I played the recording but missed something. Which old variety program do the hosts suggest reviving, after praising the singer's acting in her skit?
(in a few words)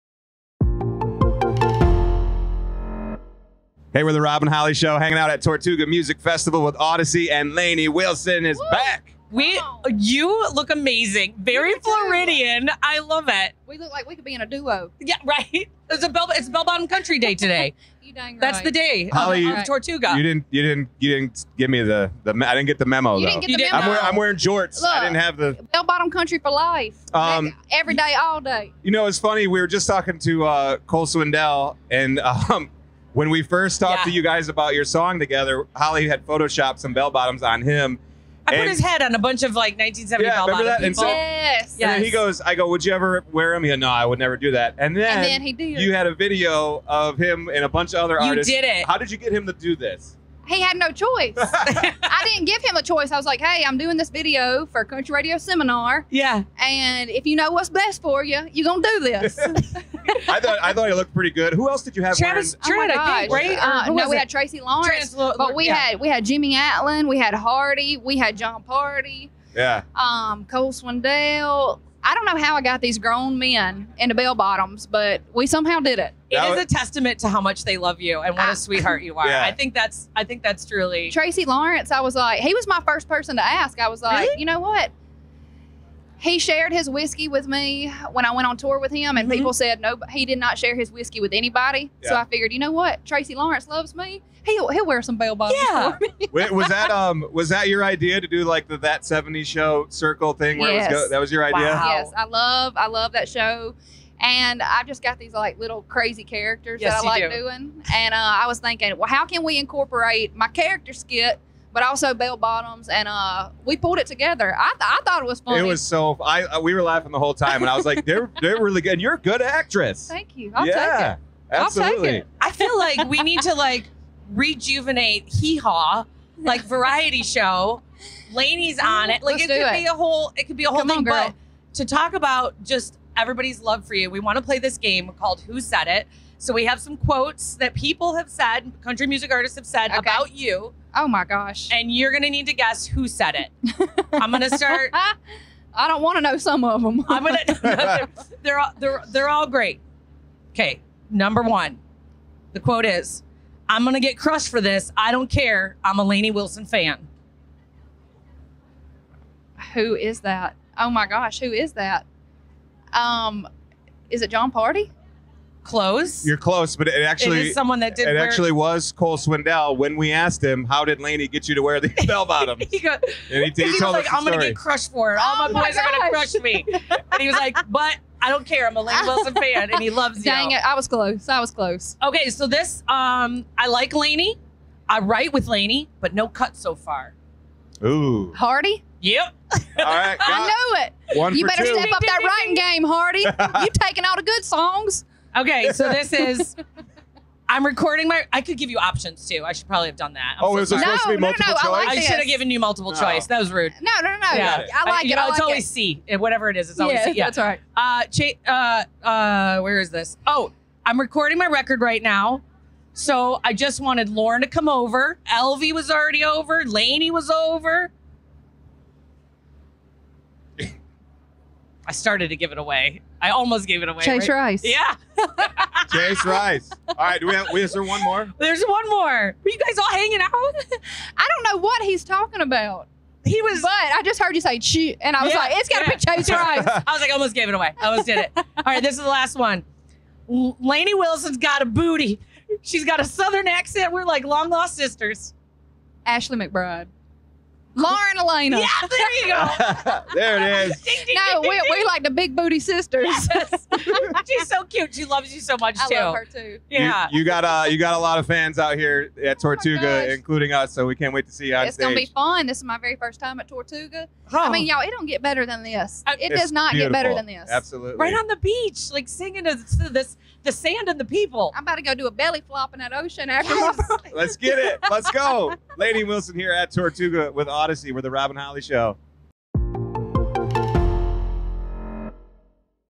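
Hee Haw.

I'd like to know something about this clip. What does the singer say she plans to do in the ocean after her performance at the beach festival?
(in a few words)
a belly flop.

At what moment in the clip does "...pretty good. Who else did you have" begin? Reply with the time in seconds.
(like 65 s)
61 s.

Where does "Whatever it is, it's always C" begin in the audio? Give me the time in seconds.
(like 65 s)
206 s.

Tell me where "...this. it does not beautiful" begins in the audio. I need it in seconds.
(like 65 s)
265 s.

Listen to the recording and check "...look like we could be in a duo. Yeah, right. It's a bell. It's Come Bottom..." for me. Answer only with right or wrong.
wrong.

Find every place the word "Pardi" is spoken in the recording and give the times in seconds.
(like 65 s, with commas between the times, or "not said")
68 s, 164 s.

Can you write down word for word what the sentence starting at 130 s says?
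On, but to talk about just everybody's love for you, we want to play this game called Who Said It.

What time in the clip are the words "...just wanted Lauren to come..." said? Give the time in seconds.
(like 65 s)
213 s.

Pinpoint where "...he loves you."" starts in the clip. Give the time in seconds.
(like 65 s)
179 s.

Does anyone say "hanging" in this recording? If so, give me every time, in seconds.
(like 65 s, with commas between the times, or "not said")
4 s, 229 s.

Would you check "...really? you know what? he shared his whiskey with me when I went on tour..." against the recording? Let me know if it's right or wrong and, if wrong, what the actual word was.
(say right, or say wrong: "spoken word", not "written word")
right.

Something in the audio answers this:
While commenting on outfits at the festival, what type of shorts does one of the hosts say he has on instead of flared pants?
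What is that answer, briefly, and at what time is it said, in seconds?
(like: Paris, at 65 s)
jorts, at 24 s.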